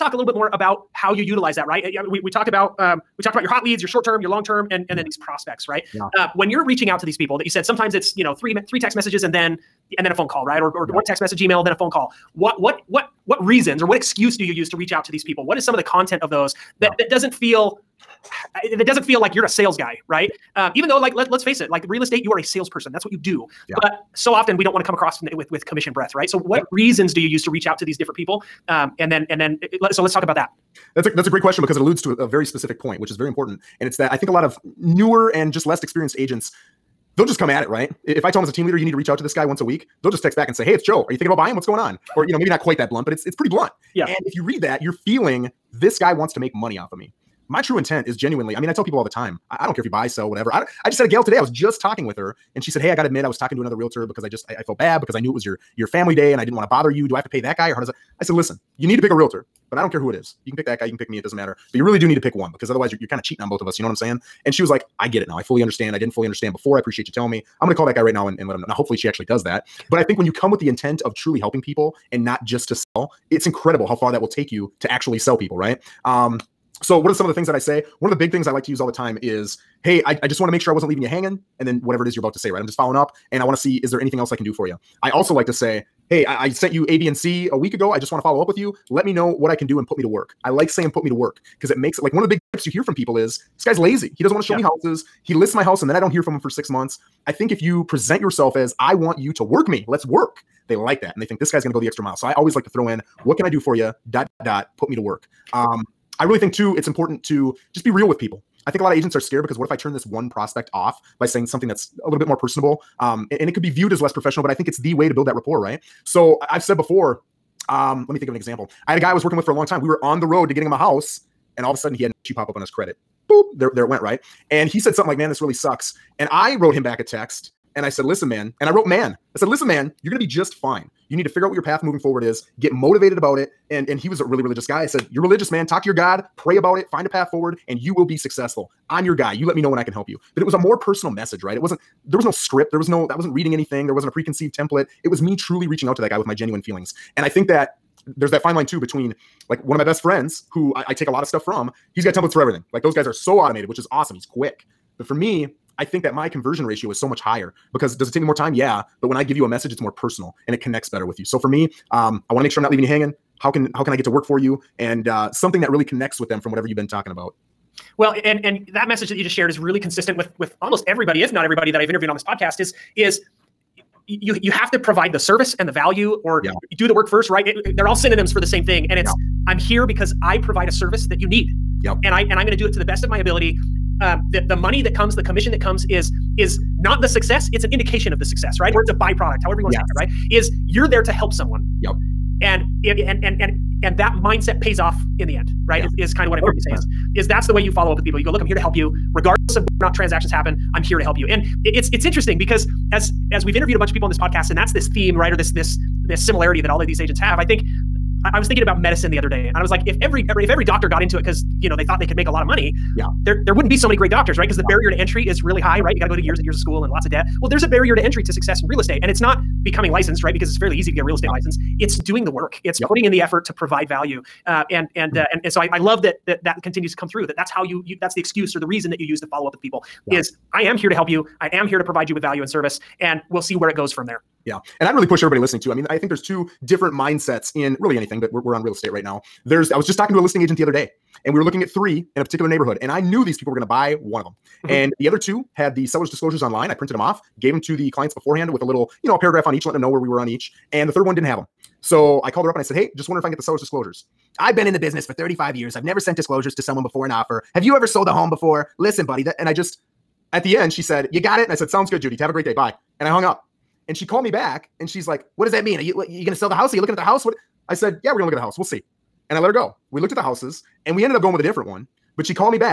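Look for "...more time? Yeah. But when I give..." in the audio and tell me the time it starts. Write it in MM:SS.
02:38.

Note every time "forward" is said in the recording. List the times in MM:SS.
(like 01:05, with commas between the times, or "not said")
02:11, 02:17.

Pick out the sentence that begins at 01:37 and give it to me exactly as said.
I think if you present yourself as, I want you to work me, let's work, they like that.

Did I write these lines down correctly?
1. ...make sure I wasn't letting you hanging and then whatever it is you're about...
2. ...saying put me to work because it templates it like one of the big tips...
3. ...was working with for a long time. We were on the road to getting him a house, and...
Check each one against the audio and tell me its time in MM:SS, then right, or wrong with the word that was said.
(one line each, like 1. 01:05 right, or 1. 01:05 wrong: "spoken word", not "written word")
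1. 01:20 wrong: "leaving", not "letting"
2. 01:30 wrong: "makes", not "templates"
3. 01:59 right.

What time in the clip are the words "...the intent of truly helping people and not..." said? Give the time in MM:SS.
01:10.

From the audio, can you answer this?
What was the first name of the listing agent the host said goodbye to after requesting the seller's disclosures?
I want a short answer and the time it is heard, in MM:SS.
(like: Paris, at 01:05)
Judy, at 04:22.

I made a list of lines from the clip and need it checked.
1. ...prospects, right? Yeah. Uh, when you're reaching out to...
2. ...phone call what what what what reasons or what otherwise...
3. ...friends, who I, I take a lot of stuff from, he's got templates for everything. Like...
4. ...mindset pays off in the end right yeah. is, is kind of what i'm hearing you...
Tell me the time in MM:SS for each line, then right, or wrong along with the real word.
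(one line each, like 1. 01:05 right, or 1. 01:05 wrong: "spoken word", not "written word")
1. 00:05 right
2. 00:11 wrong: "excuse", not "otherwise"
3. 02:30 right
4. 03:14 right.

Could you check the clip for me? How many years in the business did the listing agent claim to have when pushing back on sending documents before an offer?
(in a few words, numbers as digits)
35.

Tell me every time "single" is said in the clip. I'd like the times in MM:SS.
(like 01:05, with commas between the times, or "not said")
not said.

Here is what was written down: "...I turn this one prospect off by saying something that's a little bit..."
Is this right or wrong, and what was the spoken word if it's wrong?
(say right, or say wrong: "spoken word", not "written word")
right.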